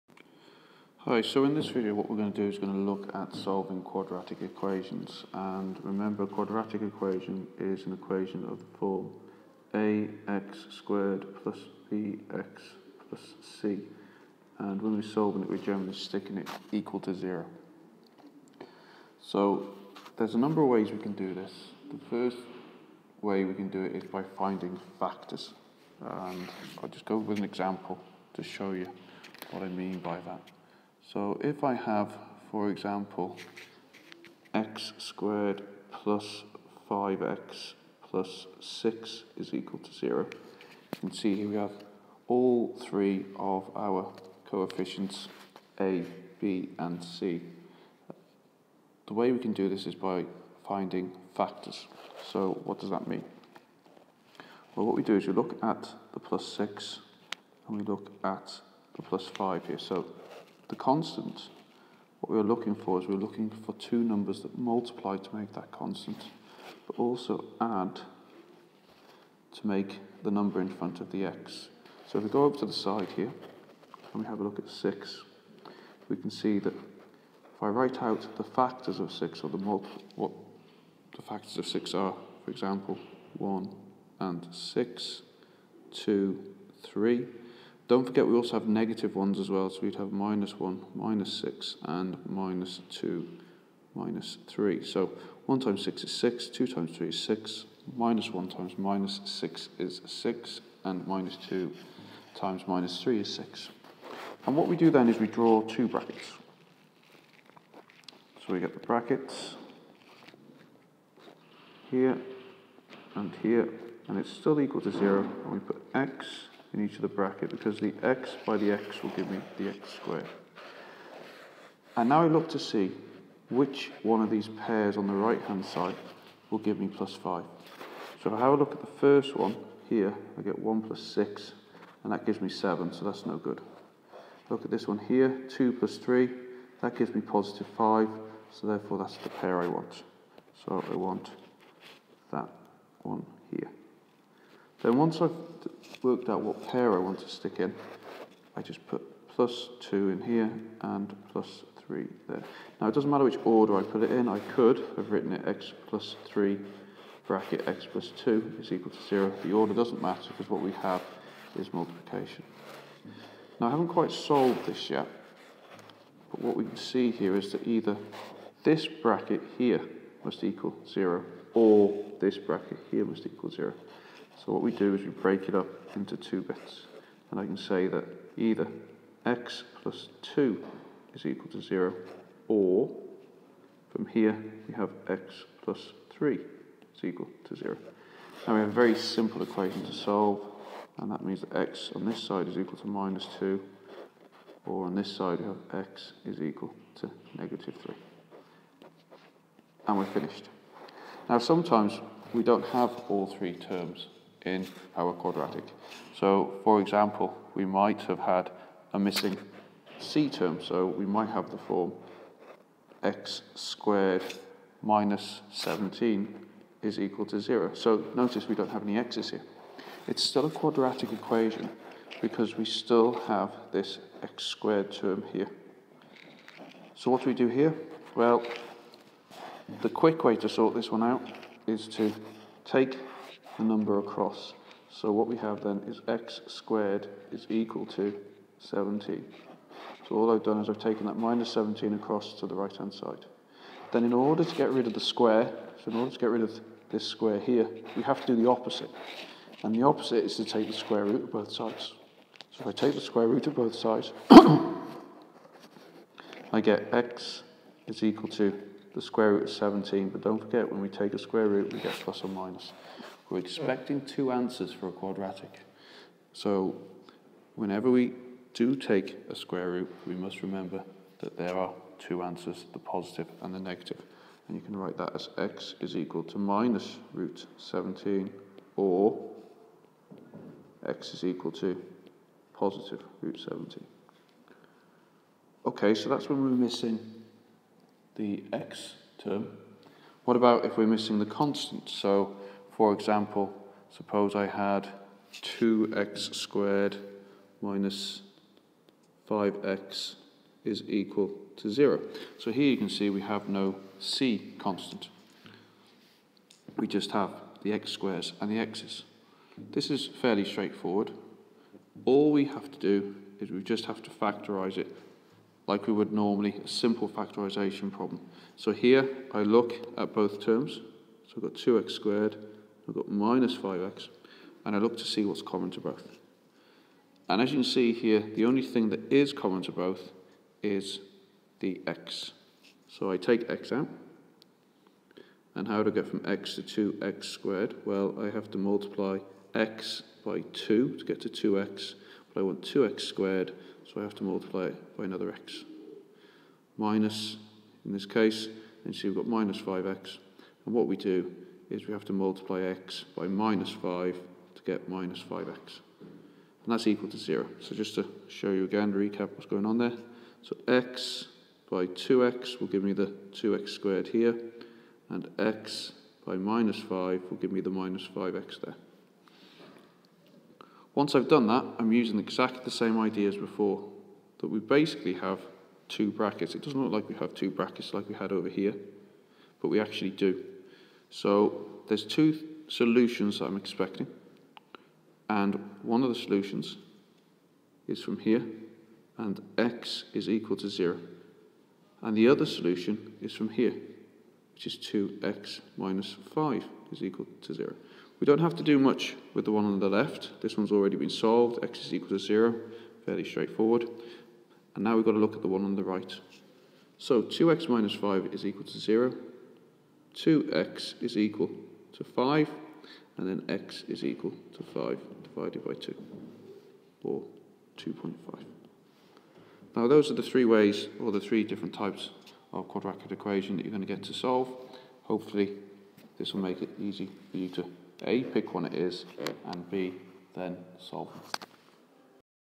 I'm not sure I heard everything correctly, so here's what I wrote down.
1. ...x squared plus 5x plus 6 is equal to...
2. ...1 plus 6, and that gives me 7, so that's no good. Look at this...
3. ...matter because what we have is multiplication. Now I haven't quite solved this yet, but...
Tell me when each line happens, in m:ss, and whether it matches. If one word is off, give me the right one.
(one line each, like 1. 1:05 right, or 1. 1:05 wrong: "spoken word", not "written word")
1. 0:34 right
2. 2:10 right
3. 2:40 right.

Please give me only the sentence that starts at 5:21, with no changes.
So I've got 2x squared I've got minus 5x, and I look to see what's common to both.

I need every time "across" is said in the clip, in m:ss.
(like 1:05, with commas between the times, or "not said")
3:53, 4:01.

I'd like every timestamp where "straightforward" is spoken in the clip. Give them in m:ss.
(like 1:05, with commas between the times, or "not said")
5:10, 6:43.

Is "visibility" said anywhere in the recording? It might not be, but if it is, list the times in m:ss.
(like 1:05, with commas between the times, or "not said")
not said.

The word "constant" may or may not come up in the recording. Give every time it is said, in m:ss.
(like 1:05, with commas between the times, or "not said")
1:00, 1:05, 4:51, 5:04.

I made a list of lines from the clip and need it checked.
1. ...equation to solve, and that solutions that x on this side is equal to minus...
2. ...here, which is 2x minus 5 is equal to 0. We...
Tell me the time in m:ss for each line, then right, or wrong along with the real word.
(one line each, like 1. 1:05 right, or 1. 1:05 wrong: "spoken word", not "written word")
1. 3:09 wrong: "means", not "solutions"
2. 6:33 right.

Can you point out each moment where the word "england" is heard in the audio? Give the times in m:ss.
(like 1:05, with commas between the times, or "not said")
not said.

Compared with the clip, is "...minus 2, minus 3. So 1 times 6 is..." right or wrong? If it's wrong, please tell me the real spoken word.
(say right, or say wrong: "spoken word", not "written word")
right.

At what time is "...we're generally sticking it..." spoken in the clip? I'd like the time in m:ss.
0:15.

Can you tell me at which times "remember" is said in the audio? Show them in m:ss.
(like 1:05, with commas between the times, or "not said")
0:05, 4:30.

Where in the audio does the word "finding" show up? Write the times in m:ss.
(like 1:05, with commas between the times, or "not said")
0:24, 0:50.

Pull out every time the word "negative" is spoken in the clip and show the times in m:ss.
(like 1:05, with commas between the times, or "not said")
1:28, 3:17, 4:33.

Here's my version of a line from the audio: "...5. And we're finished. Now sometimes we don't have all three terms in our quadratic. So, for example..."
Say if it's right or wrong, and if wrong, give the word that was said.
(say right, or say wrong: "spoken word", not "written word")
wrong: "3", not "5".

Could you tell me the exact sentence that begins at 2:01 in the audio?
And now I look to see which one of these pairs on the right hand side will give me plus 5.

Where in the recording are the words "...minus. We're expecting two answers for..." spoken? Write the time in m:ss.
4:22.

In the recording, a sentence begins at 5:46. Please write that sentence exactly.
Minus, in this case, and see we've got minus 5x.